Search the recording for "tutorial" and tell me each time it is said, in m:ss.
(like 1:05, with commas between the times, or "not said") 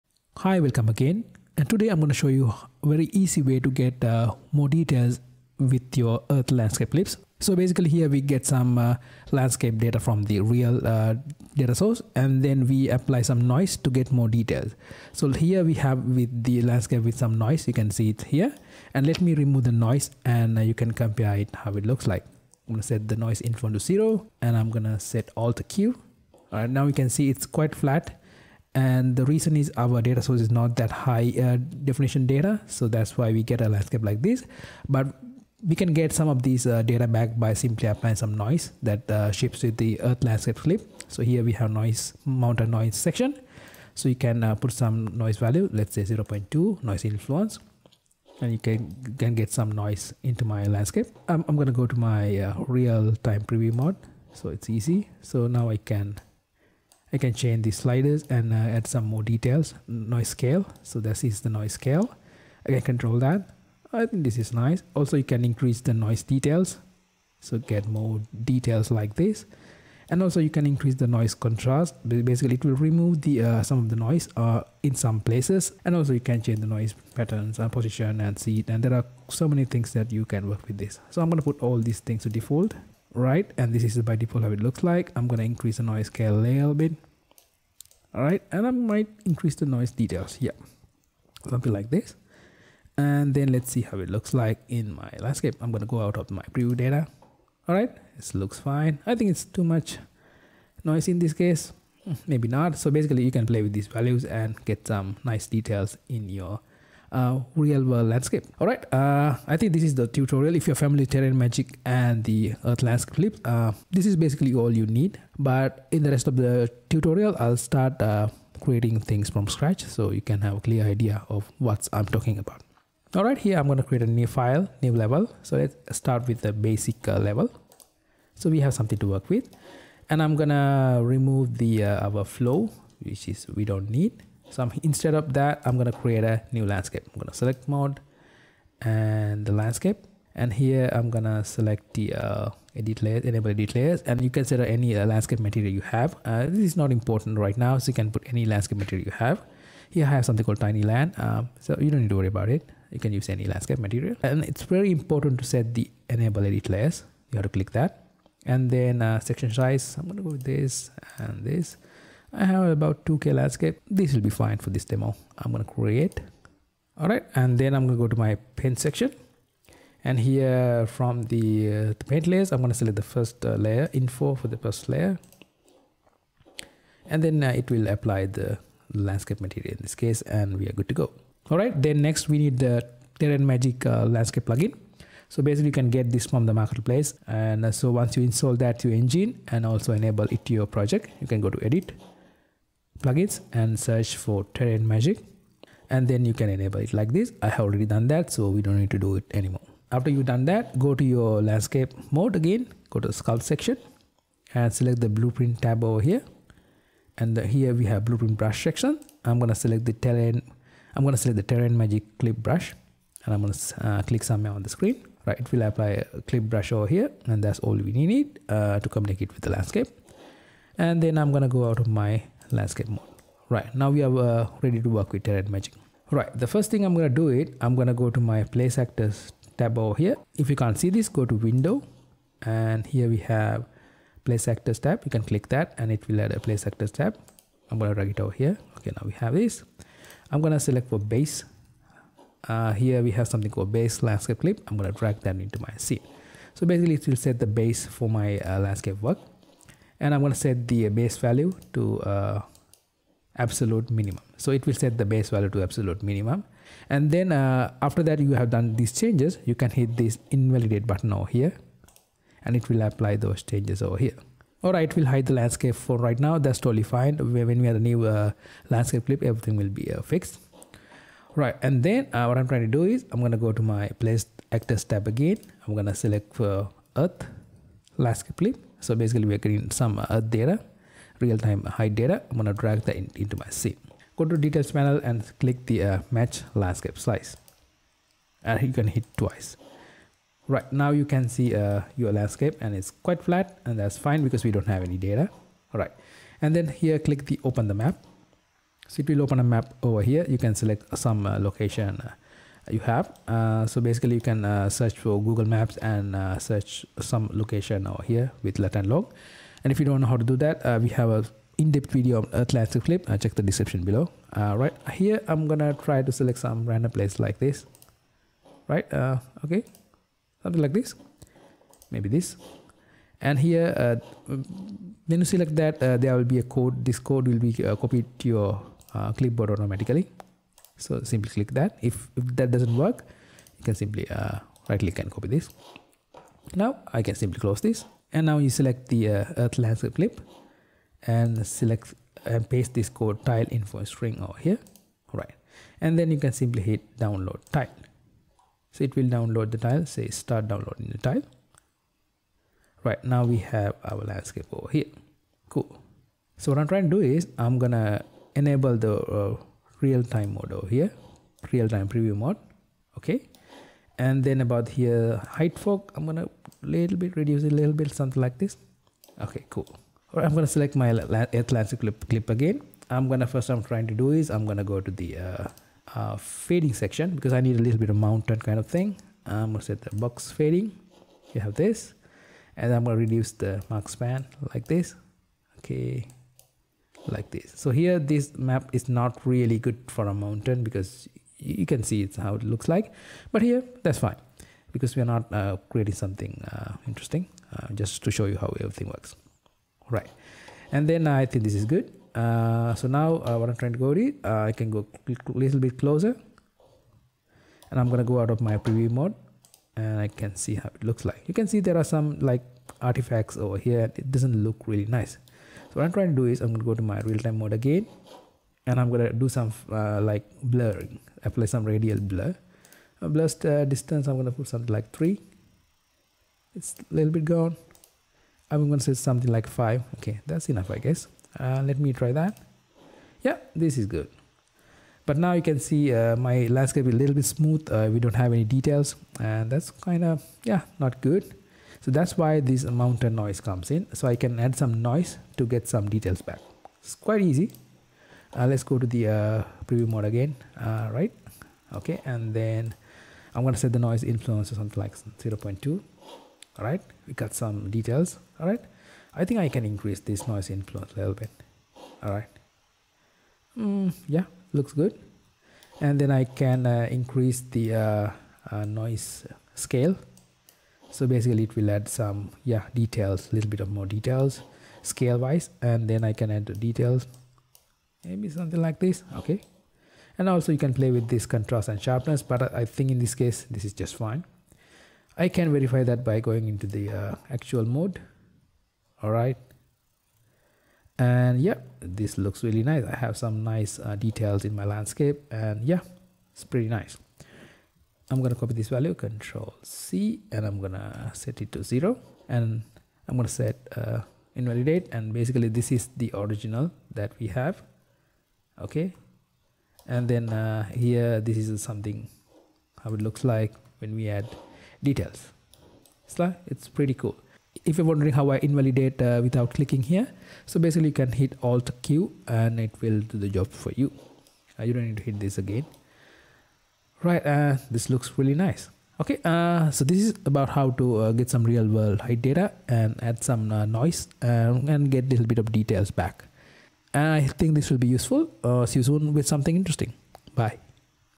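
1:50, 1:56.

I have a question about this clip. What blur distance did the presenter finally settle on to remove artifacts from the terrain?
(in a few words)
5.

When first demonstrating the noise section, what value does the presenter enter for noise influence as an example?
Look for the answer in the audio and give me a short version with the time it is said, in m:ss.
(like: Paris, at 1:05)
0.2, at 0:46.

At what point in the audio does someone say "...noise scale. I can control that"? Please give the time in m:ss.
1:01.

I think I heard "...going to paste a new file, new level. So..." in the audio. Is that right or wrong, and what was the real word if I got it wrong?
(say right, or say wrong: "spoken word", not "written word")
wrong: "create", not "paste".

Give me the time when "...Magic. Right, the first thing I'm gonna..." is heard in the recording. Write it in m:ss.
3:45.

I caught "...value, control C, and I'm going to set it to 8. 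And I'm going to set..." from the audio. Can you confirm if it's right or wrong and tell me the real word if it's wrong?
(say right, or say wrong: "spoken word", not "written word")
wrong: "0", not "8".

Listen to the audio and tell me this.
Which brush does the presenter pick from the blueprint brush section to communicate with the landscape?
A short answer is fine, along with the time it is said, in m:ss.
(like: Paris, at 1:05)
Terrain Magic clip brush, at 3:31.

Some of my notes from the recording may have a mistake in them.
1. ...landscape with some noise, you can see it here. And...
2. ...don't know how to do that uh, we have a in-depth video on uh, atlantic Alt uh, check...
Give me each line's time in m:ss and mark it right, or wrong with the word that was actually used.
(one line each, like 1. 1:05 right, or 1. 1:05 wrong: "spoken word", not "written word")
1. 0:16 right
2. 5:09 wrong: "Flip", not "Alt".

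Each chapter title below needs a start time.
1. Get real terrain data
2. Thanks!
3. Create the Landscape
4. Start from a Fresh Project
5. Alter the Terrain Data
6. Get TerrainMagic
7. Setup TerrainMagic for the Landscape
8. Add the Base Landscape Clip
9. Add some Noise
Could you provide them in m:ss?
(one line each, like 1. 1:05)
1. 4:31
2. 8:56
3. 2:20
4. 2:02
5. 5:56
6. 3:01
7. 3:19
8. 3:45
9. 7:27.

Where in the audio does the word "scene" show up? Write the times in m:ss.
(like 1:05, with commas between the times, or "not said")
4:05, 4:43.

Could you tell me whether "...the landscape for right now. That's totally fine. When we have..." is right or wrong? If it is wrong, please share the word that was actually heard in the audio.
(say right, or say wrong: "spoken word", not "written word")
right.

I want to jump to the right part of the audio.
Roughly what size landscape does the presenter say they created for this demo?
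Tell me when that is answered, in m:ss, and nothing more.
2:43.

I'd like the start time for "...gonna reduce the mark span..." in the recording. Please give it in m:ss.
6:22.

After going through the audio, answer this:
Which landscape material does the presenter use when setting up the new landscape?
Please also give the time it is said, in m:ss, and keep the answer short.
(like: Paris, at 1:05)
tiny land, at 2:30.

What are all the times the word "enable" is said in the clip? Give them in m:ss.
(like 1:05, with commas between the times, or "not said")
2:23, 2:36, 3:09, 3:16, 5:58.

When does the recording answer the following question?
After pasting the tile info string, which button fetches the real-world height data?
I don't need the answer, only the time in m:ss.
5:46.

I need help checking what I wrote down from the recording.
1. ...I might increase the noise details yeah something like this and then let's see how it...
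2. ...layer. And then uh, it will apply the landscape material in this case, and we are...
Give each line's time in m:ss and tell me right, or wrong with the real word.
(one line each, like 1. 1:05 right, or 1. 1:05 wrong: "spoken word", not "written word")
1. 1:28 right
2. 2:54 right.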